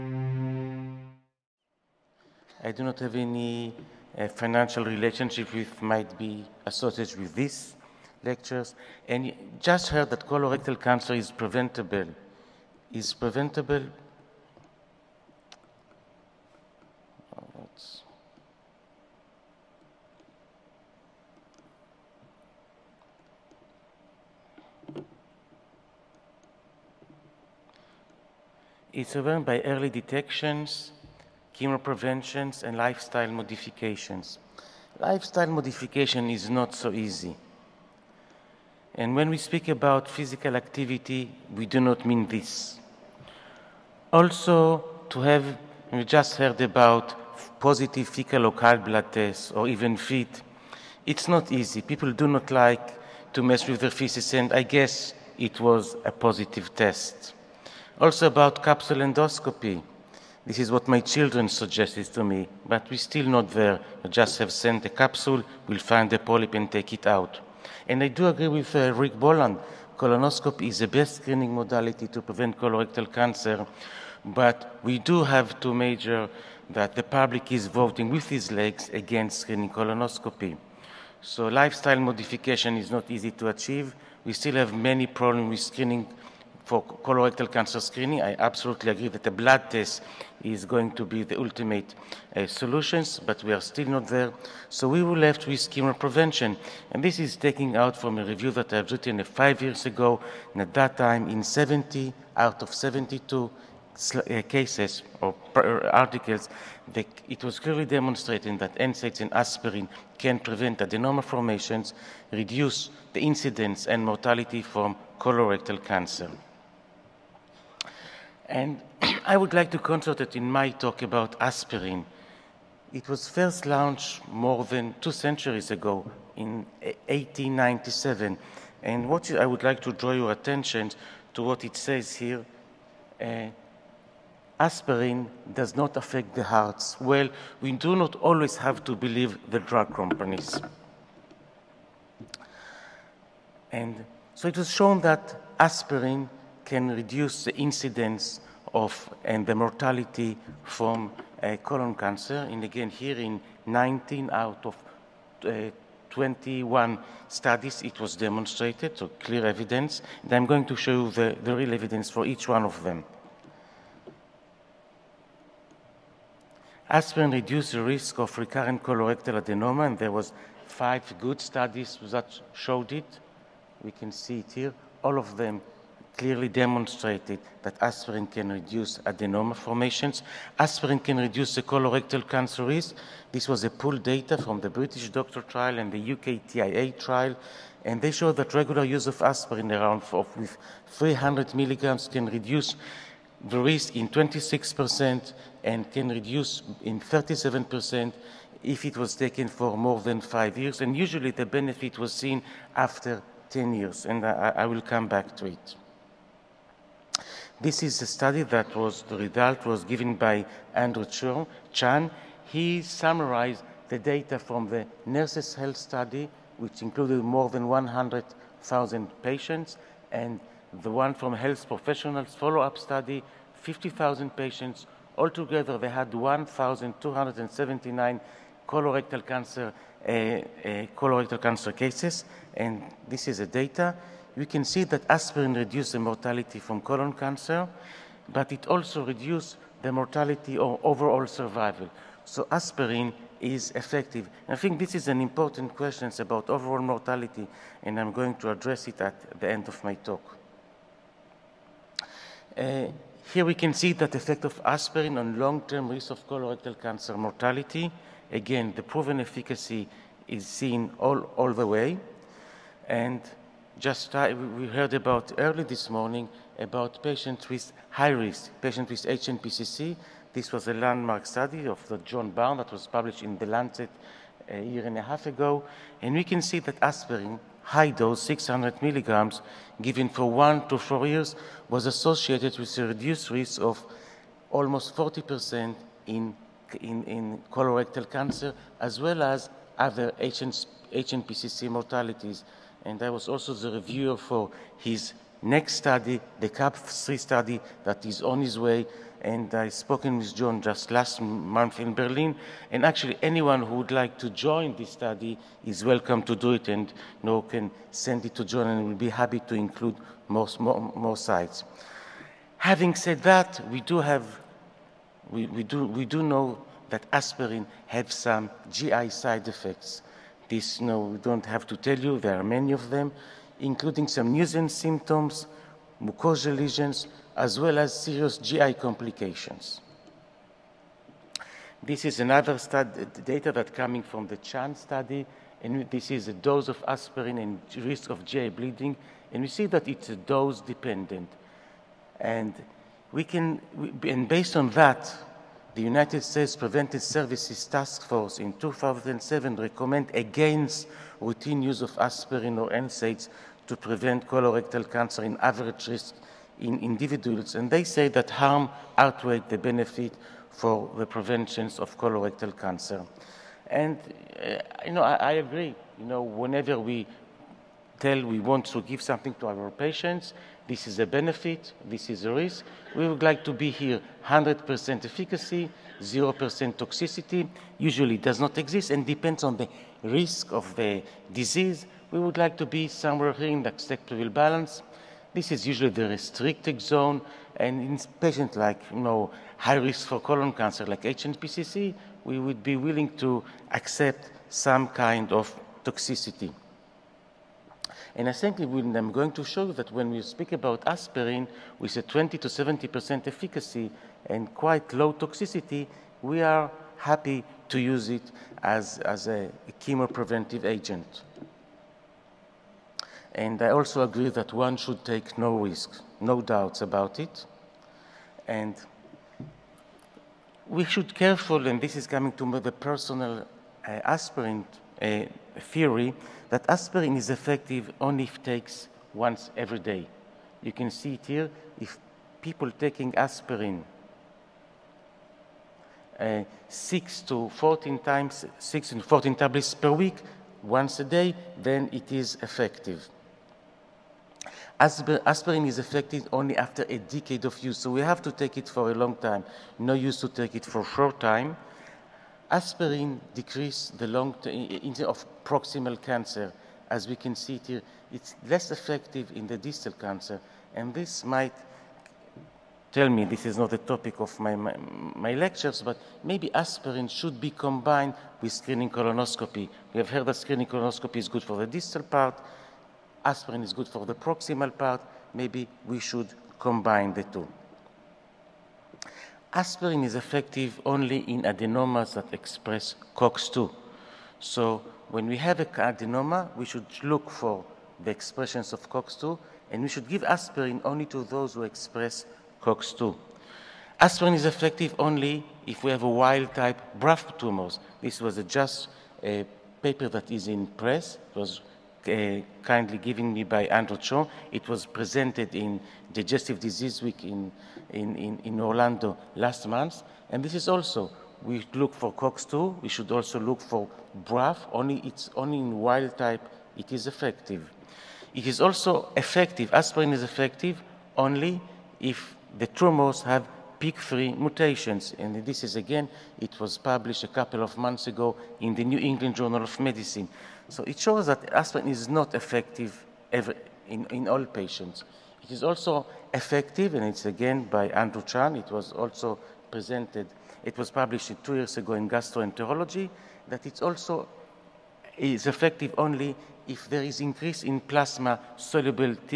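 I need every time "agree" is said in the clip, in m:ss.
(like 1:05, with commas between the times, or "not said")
1:08, 1:28, 6:05, 6:54.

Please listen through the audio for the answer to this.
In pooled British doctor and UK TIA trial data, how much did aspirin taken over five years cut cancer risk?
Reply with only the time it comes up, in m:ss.
3:16.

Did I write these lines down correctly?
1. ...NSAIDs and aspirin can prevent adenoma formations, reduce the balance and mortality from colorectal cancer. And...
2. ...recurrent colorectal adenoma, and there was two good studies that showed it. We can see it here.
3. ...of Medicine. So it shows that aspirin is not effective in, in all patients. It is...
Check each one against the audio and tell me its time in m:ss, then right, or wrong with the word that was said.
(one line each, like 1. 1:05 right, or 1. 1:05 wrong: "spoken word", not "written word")
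1. 1:48 wrong: "incidence", not "balance"
2. 2:48 wrong: "five", not "two"
3. 8:49 right.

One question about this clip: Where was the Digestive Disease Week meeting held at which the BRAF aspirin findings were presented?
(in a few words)
Orlando.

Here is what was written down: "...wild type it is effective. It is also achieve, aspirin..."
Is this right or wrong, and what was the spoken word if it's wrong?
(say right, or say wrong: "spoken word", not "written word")
wrong: "effective", not "achieve".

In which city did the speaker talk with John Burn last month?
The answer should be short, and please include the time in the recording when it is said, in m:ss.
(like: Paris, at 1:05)
Berlin, at 5:01.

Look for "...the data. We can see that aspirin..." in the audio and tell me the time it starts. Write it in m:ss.
3:53.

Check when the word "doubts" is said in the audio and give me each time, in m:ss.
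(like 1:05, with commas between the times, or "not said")
6:56.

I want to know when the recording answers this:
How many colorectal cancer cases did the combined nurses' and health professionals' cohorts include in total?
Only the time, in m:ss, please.
3:46.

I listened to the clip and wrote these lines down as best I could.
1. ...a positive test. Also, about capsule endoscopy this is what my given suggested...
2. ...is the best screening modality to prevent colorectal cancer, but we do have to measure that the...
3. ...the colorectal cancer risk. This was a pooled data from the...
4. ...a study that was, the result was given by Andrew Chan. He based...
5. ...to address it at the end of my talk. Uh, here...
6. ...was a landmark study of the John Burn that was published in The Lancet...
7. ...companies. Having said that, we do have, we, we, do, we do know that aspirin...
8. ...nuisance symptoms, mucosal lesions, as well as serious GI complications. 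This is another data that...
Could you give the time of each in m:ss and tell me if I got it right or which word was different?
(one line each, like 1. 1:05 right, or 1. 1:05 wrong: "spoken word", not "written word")
1. 0:56 wrong: "children", not "given"
2. 1:10 right
3. 3:01 right
4. 3:28 wrong: "summarized", not "based"
5. 4:08 right
6. 4:30 right
7. 5:11 wrong: "sites", not "companies"
8. 5:24 right.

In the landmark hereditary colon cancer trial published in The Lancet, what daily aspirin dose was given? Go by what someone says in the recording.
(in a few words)
600 milligrams.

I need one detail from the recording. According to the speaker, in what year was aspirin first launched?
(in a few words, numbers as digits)
1897.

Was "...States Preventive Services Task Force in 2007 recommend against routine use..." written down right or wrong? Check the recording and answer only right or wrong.
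right.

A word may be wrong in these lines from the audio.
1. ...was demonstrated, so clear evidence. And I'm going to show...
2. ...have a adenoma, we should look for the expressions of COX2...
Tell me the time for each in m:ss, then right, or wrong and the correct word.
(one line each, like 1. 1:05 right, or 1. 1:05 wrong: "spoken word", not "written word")
1. 2:37 right
2. 8:05 right.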